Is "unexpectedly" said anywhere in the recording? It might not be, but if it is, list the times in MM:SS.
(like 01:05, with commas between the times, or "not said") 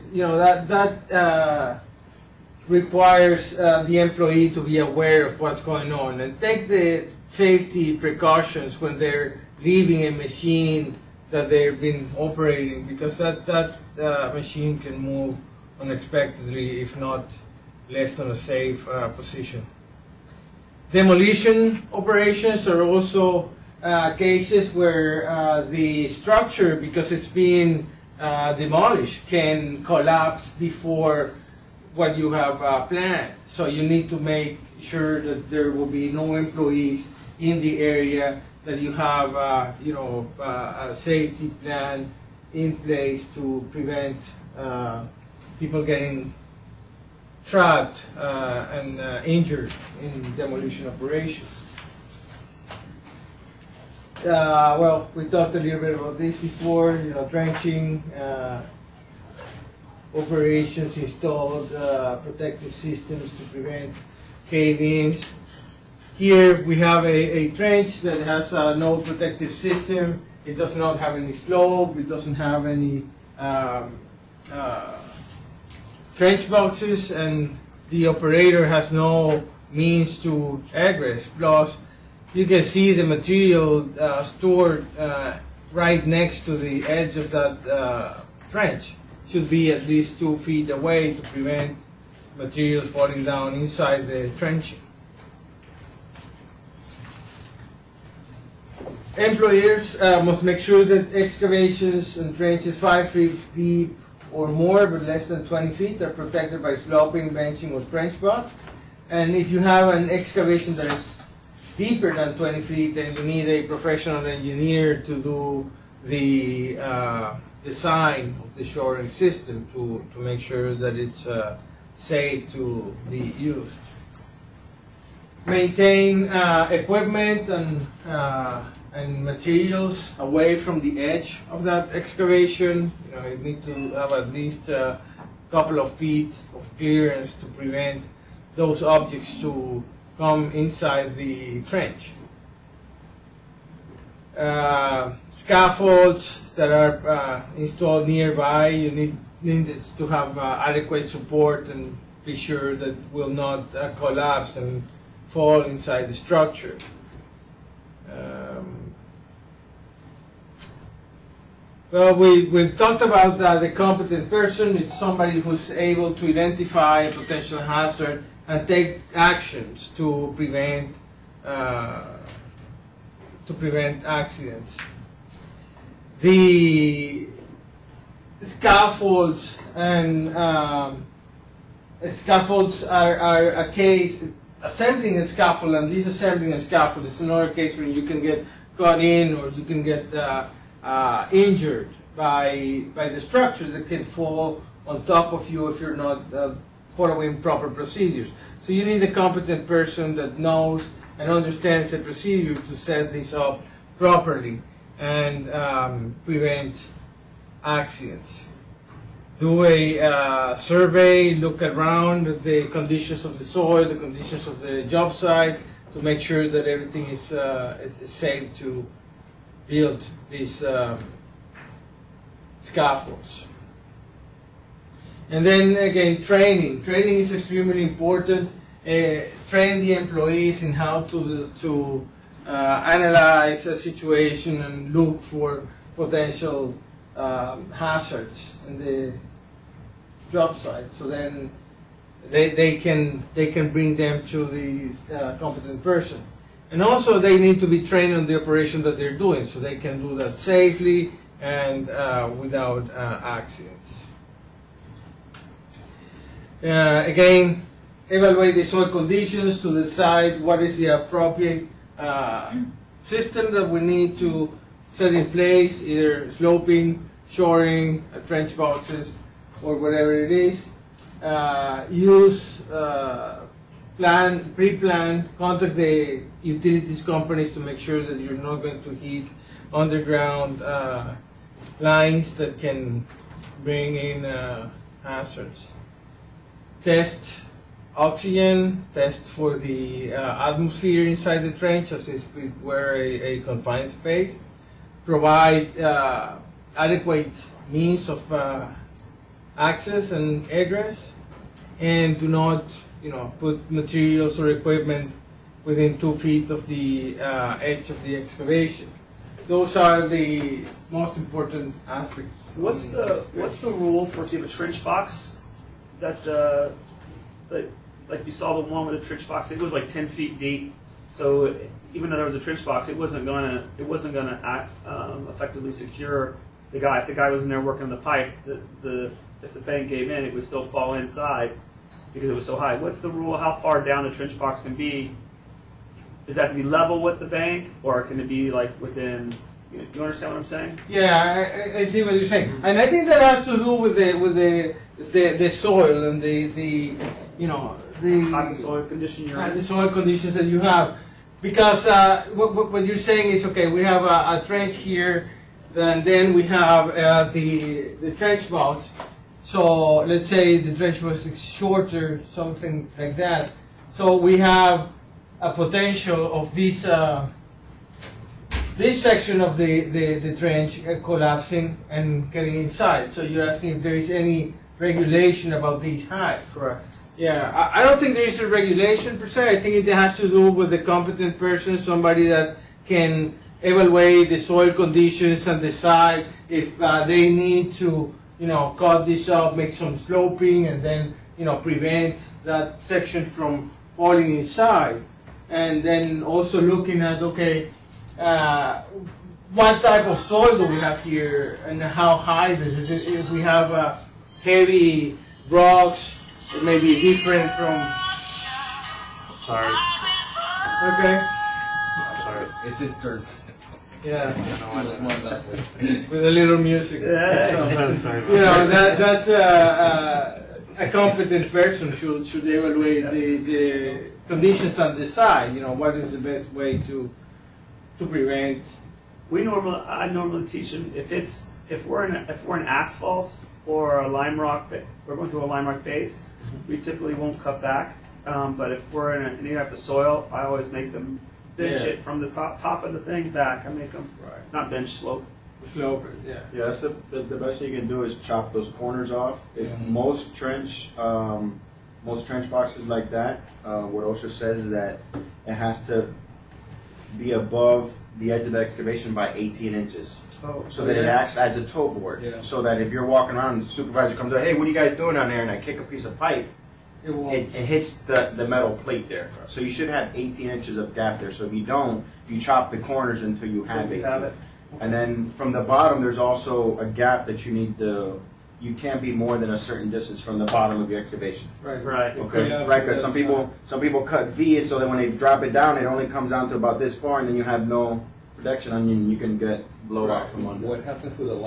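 00:15.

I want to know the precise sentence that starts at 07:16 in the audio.
We typically won't cut back, um, but if we're in a, any type of soil, I always make them bench yeah.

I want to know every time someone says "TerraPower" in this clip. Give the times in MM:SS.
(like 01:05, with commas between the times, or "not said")
not said.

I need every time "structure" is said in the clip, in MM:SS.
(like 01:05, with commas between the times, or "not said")
00:26, 02:36, 03:13.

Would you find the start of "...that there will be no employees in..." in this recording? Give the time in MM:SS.
00:35.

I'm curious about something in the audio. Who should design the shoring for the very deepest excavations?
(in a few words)
a professional engineer.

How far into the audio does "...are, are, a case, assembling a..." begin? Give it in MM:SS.
03:02.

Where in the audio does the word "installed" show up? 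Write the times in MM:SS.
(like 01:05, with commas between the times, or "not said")
01:00, 02:27.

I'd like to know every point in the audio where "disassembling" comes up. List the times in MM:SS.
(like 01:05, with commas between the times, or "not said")
03:05.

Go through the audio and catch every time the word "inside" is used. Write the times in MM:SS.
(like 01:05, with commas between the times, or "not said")
01:33, 02:20, 02:35, 04:51, 05:30, 06:12, 06:34.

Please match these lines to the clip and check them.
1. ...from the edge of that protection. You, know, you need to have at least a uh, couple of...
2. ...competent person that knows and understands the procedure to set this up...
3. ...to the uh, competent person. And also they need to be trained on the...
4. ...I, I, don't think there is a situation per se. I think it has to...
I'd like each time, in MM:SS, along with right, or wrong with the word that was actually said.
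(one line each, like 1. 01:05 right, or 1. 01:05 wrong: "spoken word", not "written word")
1. 02:10 wrong: "excavation", not "protection"
2. 03:19 right
3. 04:04 right
4. 06:17 wrong: "regulation", not "situation".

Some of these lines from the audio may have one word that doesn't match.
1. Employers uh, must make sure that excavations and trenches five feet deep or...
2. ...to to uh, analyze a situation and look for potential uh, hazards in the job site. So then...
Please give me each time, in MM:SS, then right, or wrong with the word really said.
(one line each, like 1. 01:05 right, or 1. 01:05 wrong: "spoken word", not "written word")
1. 01:39 right
2. 03:51 right.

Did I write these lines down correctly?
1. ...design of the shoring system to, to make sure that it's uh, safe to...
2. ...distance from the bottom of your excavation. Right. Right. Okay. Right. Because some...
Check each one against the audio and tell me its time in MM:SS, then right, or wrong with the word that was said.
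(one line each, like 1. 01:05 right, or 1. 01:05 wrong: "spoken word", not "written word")
1. 01:57 right
2. 07:59 right.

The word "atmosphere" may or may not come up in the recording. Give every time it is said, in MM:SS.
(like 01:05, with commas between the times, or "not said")
04:50.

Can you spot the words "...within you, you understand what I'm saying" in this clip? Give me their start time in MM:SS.
05:38.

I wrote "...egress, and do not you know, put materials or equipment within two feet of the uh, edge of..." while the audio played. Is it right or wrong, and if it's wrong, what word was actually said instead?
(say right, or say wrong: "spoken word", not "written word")
right.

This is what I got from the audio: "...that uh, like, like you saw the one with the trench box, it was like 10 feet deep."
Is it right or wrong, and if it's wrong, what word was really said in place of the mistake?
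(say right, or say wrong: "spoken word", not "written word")
right.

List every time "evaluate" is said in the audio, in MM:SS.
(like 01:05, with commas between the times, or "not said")
04:18, 06:23, 07:02.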